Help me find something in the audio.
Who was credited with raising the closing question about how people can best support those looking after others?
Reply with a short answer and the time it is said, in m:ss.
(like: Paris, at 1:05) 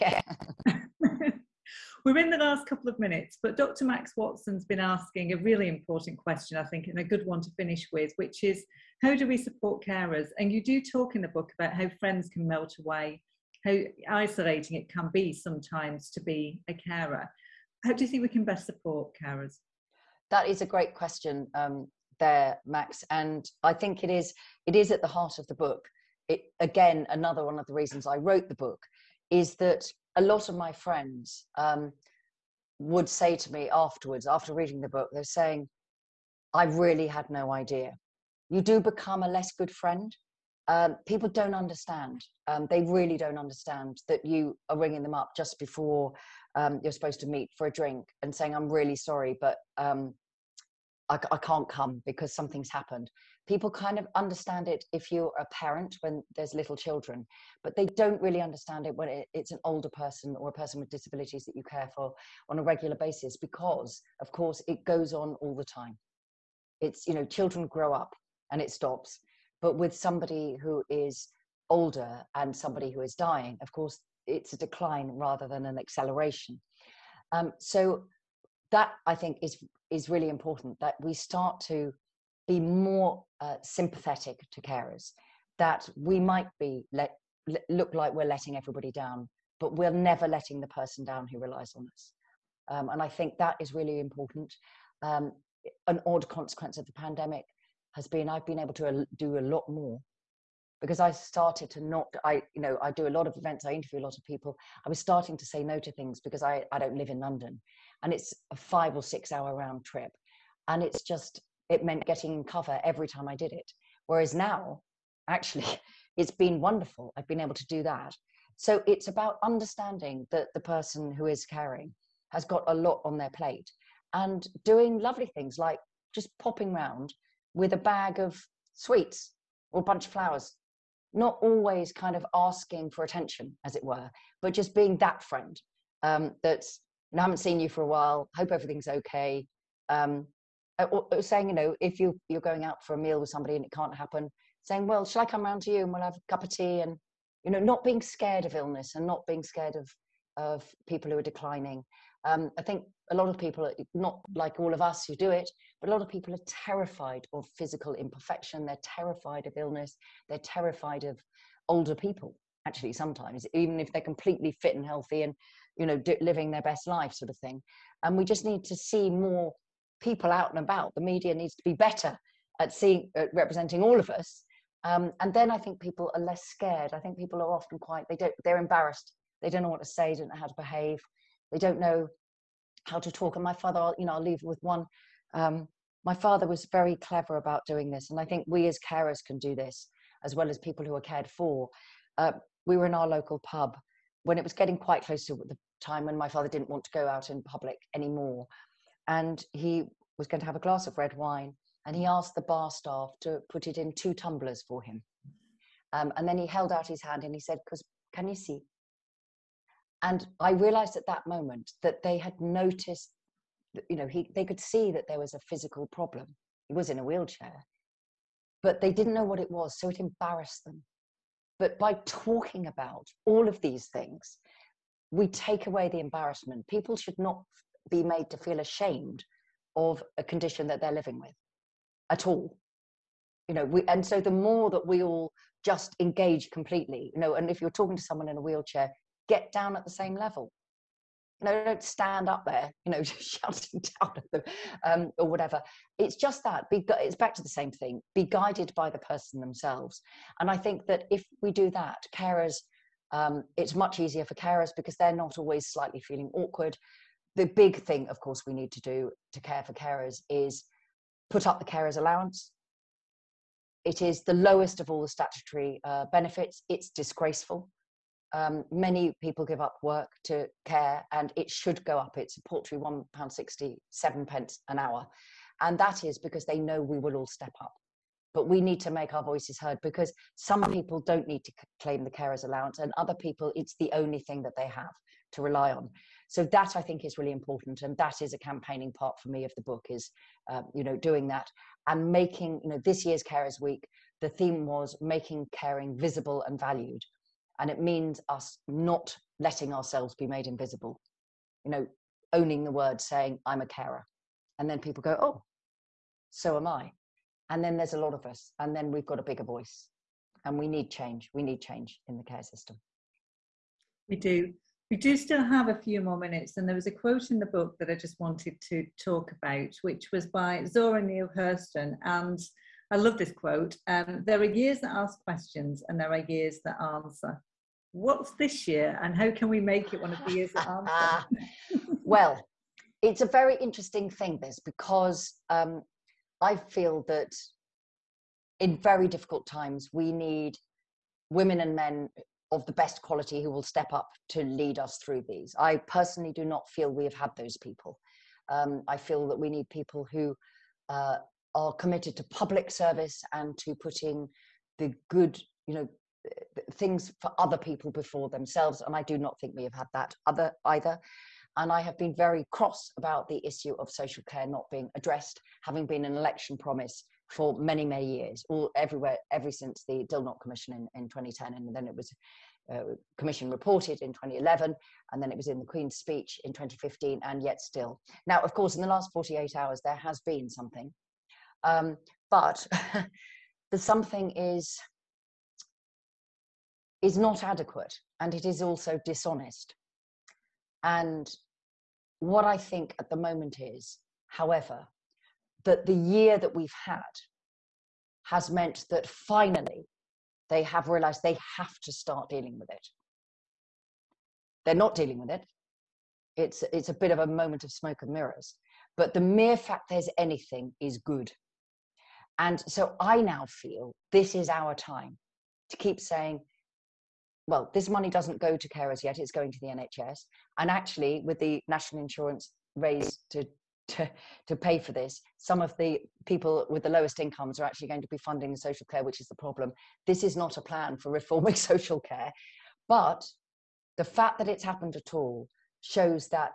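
Dr. Max Watson, at 0:03.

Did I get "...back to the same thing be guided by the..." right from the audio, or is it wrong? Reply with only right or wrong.
right.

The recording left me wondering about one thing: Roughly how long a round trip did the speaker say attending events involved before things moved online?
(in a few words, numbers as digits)
5 or 6 hours.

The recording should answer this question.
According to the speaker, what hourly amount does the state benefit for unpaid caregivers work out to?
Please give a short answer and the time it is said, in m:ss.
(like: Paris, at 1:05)
£1.67, at 4:32.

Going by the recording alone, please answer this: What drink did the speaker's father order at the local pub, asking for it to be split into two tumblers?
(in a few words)
red wine.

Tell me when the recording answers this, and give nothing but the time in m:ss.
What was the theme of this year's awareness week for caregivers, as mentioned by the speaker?
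4:54.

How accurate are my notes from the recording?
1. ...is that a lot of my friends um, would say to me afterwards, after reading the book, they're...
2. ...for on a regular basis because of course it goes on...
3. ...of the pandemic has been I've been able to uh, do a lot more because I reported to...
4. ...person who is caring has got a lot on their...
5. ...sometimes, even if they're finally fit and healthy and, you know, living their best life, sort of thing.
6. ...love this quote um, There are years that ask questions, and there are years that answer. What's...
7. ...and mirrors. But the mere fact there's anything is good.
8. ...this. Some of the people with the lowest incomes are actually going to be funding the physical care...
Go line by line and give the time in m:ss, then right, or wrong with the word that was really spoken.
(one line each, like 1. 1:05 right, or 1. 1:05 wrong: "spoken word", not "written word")
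1. 0:29 right
2. 1:01 right
3. 1:36 wrong: "started", not "reported"
4. 2:00 right
5. 2:42 wrong: "completely", not "finally"
6. 5:22 right
7. 6:48 right
8. 7:04 wrong: "social", not "physical".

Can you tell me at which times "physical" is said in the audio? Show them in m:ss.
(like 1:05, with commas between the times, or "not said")
2:37, 3:35.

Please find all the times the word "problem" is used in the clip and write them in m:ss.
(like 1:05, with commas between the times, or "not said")
3:35, 7:09.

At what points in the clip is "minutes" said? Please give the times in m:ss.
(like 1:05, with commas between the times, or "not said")
0:02, 5:16.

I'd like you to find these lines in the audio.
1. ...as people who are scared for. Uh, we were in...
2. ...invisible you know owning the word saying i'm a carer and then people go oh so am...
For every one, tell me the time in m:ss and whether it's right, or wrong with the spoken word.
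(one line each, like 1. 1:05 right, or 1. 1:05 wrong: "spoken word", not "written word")
1. 3:10 wrong: "cared", not "scared"
2. 5:00 right.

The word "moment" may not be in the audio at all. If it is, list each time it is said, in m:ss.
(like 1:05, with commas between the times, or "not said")
3:31, 6:33, 6:47.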